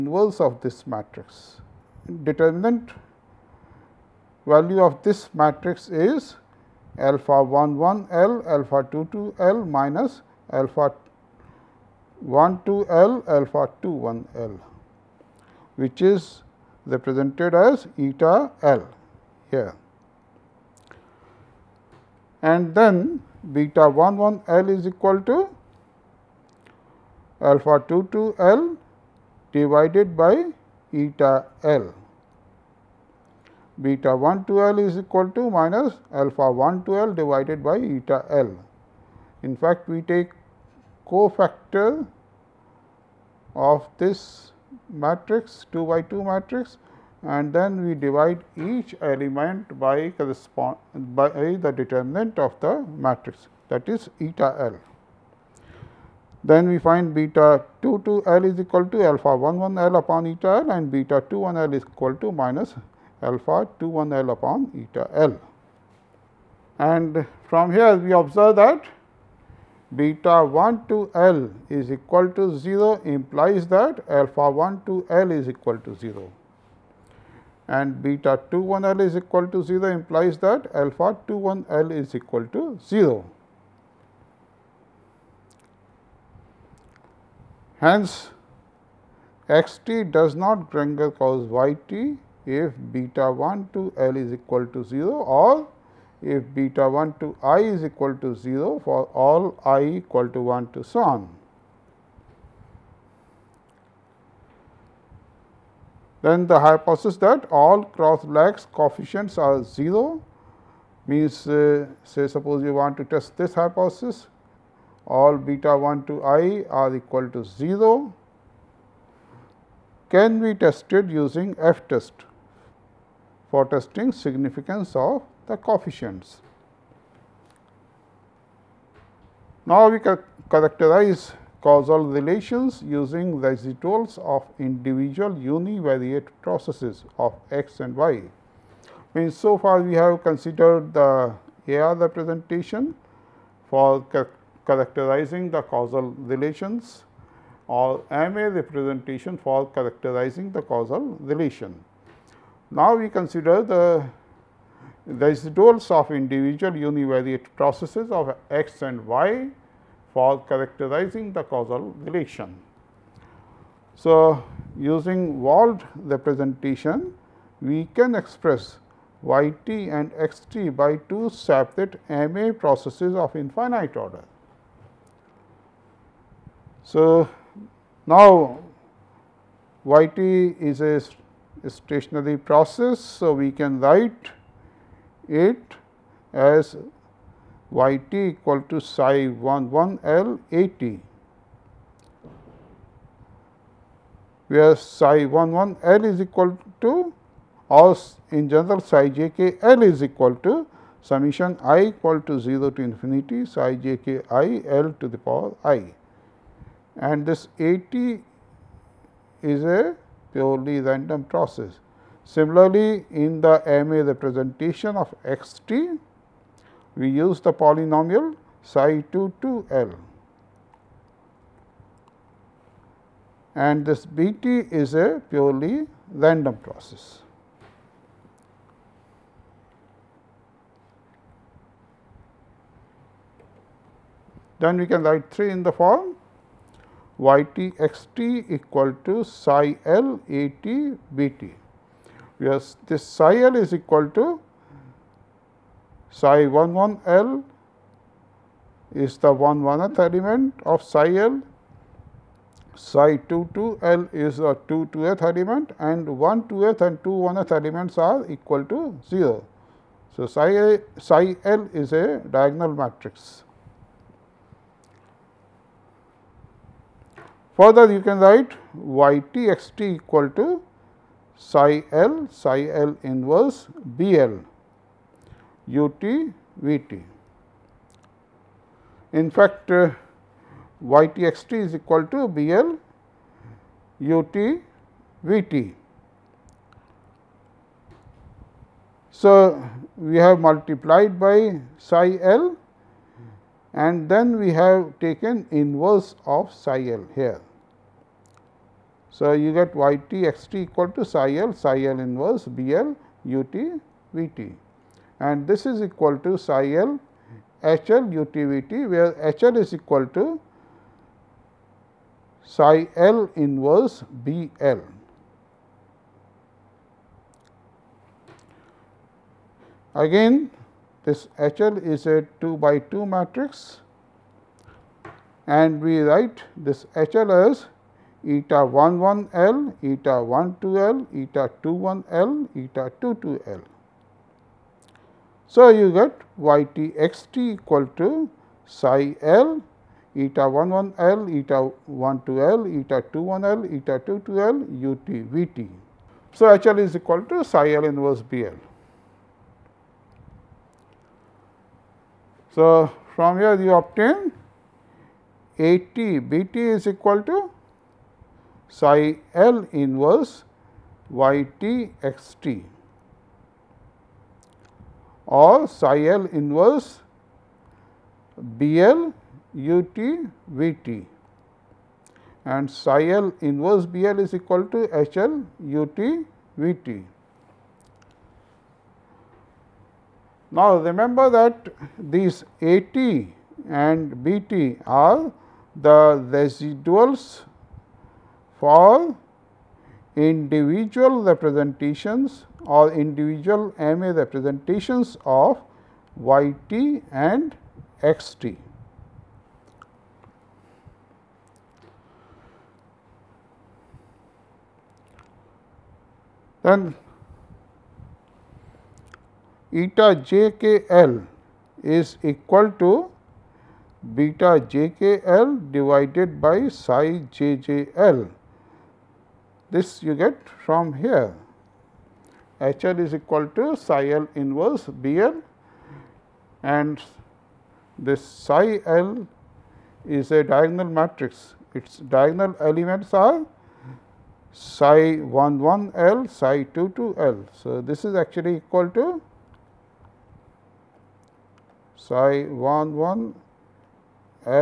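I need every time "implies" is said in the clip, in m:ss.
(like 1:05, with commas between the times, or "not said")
1:13, 1:19.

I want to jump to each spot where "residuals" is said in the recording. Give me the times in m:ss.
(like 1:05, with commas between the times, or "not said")
2:13, 2:35, 6:26.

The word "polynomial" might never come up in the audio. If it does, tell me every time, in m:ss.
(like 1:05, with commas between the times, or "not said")
3:37.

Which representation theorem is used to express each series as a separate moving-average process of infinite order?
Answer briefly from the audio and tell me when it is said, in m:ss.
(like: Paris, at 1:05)
Wold representation, at 2:45.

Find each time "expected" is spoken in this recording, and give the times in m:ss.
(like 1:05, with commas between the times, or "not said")
not said.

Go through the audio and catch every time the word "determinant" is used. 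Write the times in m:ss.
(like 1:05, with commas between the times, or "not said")
0:02, 0:51.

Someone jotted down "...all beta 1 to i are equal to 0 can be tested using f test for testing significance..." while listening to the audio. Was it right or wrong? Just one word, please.
right.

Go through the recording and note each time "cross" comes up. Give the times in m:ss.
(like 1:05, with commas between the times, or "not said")
1:47.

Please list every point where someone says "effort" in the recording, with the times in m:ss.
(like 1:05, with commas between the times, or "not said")
not said.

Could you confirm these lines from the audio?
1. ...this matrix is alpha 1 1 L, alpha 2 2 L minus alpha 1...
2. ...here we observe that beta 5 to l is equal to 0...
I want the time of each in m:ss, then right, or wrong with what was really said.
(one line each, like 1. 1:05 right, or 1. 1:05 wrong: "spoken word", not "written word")
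1. 0:05 right
2. 1:07 wrong: "1", not "5".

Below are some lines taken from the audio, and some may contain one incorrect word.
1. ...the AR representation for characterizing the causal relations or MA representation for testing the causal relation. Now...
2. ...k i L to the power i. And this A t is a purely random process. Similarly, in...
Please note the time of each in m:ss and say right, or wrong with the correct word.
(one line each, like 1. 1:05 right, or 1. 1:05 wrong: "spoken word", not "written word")
1. 2:20 wrong: "characterizing", not "testing"
2. 3:24 right.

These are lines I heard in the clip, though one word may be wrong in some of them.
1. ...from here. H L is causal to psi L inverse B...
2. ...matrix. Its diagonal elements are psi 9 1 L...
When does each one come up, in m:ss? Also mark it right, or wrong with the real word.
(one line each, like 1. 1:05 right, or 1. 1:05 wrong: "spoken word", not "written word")
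1. 7:00 wrong: "equal", not "causal"
2. 7:11 wrong: "1", not "9".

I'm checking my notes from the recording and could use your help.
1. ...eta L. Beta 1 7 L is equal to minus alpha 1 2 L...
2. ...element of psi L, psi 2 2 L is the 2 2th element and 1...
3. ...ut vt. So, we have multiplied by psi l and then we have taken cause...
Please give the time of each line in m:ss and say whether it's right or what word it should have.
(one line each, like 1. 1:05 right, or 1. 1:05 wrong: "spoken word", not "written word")
1. 0:31 wrong: "2", not "7"
2. 4:10 right
3. 4:44 wrong: "inverse", not "cause".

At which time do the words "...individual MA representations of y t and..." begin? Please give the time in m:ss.
6:32.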